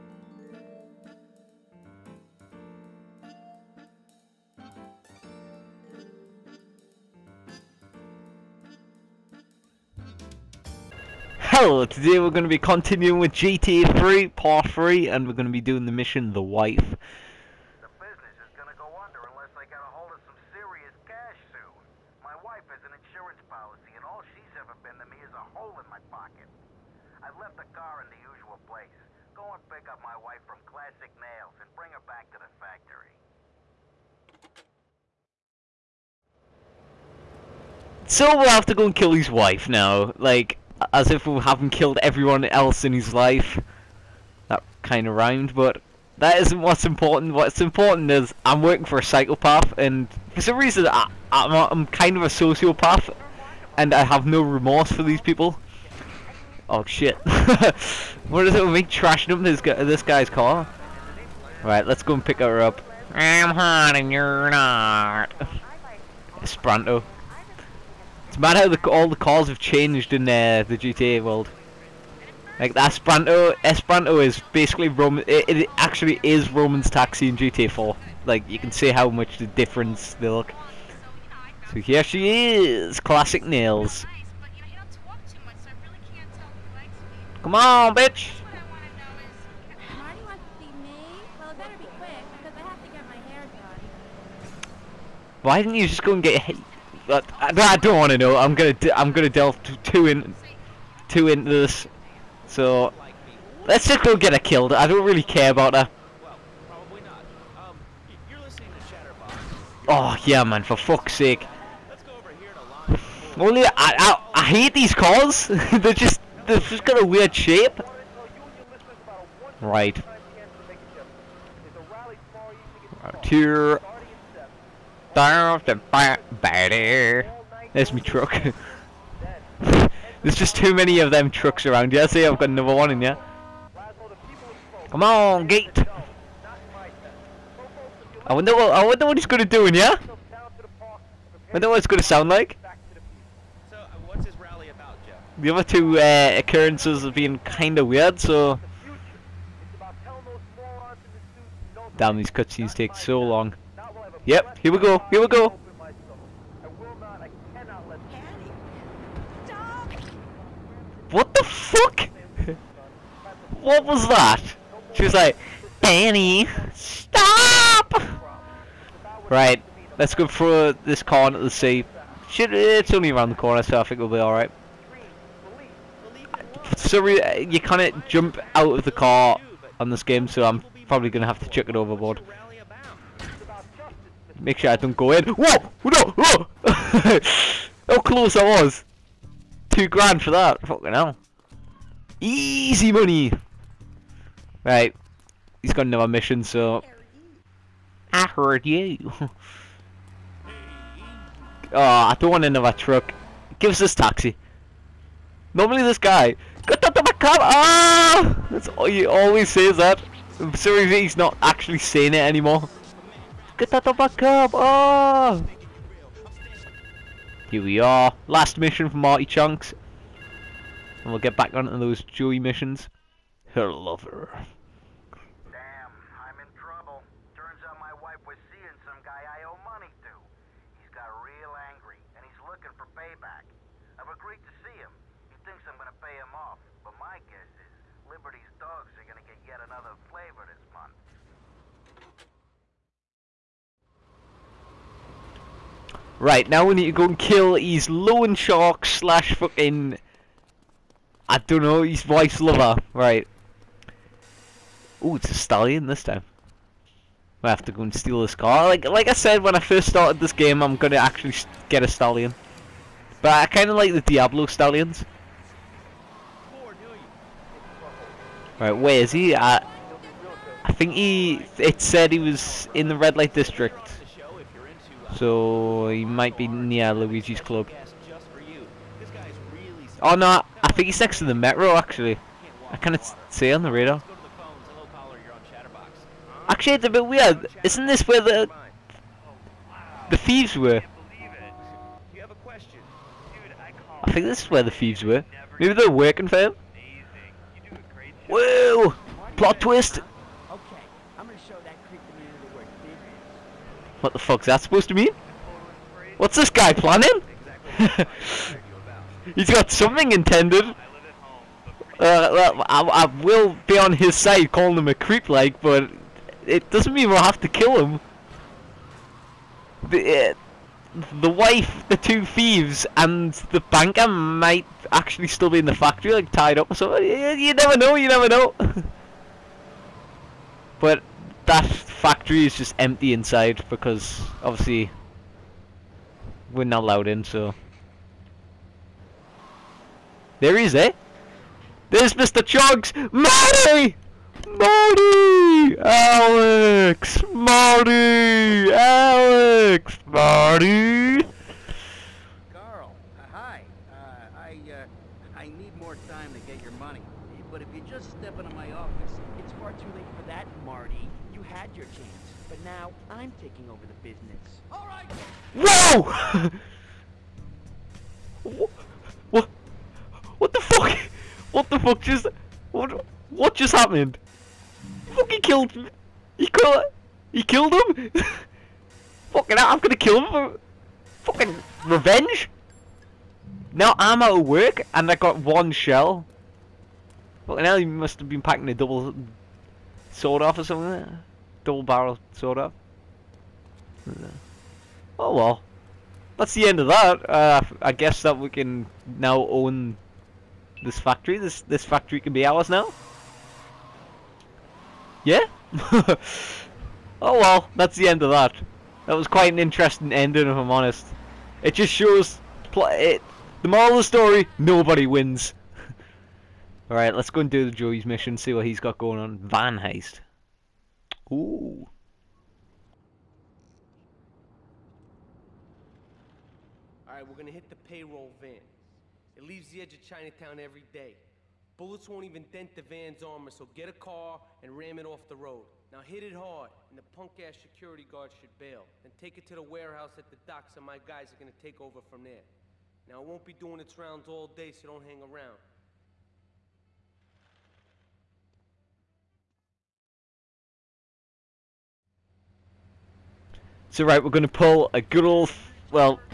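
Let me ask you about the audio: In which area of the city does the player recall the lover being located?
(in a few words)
Red light district.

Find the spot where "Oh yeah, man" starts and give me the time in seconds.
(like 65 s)
109 s.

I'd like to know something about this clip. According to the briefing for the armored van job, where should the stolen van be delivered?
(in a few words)
warehouse at the docks.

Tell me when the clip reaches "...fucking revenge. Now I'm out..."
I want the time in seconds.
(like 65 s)
381 s.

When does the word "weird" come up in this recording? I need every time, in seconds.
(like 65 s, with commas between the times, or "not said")
117 s, 147 s, 287 s.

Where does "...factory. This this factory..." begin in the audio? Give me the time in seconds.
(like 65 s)
400 s.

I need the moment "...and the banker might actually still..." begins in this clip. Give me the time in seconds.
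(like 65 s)
322 s.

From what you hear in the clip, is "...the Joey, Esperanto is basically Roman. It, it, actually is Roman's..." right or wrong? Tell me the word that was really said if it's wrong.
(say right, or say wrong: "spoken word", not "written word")
wrong: "Esperanto", not "Joey".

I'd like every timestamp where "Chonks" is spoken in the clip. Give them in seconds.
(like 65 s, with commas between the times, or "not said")
219 s, 342 s.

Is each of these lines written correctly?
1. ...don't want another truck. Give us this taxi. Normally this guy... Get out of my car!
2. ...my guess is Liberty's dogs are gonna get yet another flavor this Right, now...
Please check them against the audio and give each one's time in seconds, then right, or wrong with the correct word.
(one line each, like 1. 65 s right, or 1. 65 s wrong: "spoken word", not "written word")
1. 202 s right
2. 236 s right.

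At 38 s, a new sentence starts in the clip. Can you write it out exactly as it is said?
So we'll have to go and kill his wife now, like as if we haven't killed everyone else in his life.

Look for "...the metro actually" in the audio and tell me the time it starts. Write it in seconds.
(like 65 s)
281 s.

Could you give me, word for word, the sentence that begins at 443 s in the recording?
Now, it won't be doing its rounds all day, so don't hang around.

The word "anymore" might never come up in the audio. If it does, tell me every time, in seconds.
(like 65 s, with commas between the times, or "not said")
212 s.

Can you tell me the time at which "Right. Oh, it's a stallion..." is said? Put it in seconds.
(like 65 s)
252 s.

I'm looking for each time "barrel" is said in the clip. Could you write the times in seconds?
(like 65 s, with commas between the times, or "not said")
391 s.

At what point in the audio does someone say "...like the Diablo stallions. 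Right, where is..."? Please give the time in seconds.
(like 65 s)
263 s.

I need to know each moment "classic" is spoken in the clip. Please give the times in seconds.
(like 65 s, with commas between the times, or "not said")
30 s, 82 s.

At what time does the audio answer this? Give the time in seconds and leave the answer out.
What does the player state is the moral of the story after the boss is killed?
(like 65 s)
414 s.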